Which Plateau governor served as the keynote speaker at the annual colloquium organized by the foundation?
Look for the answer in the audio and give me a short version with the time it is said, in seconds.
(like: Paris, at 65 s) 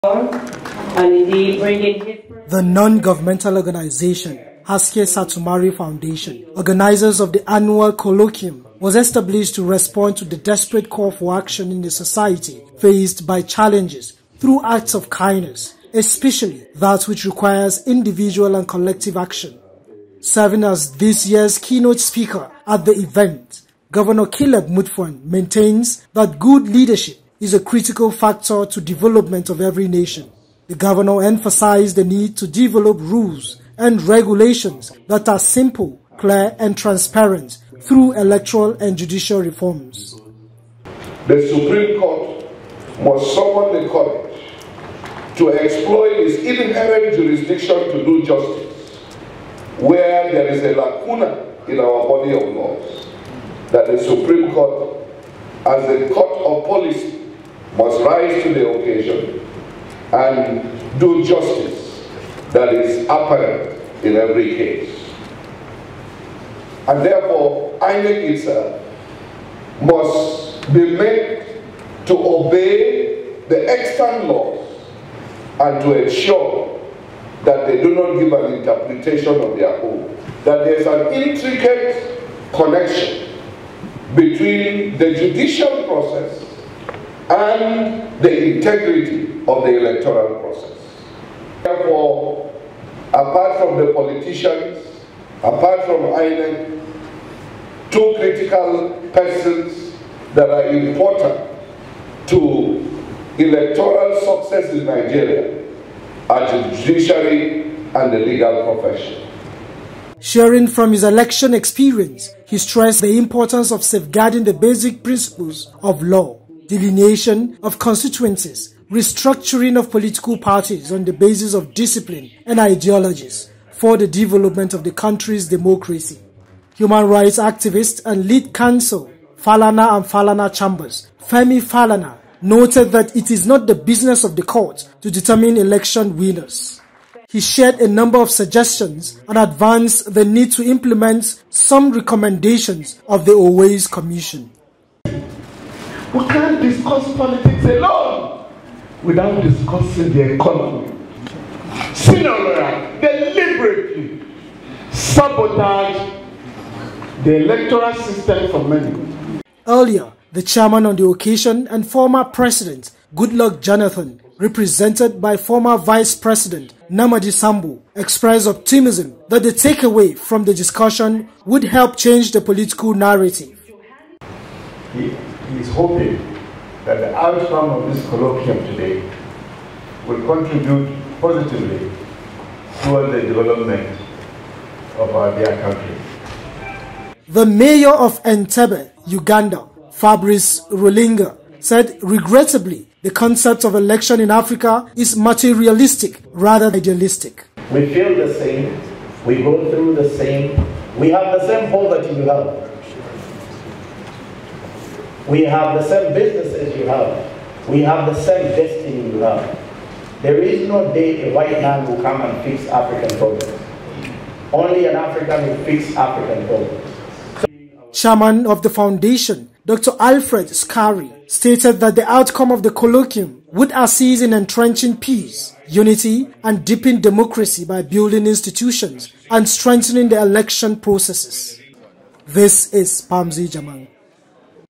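Caleb Mutfwang, at 24 s.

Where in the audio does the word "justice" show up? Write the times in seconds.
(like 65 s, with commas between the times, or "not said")
48 s, 61 s.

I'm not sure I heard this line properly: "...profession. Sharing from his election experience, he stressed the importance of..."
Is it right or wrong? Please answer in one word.
right.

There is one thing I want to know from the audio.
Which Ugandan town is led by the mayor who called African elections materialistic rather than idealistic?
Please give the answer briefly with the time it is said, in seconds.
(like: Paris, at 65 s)
Entebbe, at 188 s.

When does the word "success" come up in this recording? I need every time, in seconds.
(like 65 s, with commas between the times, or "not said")
104 s.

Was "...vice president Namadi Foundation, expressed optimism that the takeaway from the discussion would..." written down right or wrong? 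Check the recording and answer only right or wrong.
wrong.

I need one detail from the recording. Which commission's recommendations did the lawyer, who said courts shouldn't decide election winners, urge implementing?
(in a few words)
Uwais Commission.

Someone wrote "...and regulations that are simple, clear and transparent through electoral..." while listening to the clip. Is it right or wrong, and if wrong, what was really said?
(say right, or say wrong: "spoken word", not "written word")
right.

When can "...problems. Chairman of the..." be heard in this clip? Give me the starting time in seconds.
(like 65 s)
216 s.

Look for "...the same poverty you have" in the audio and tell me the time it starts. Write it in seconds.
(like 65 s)
201 s.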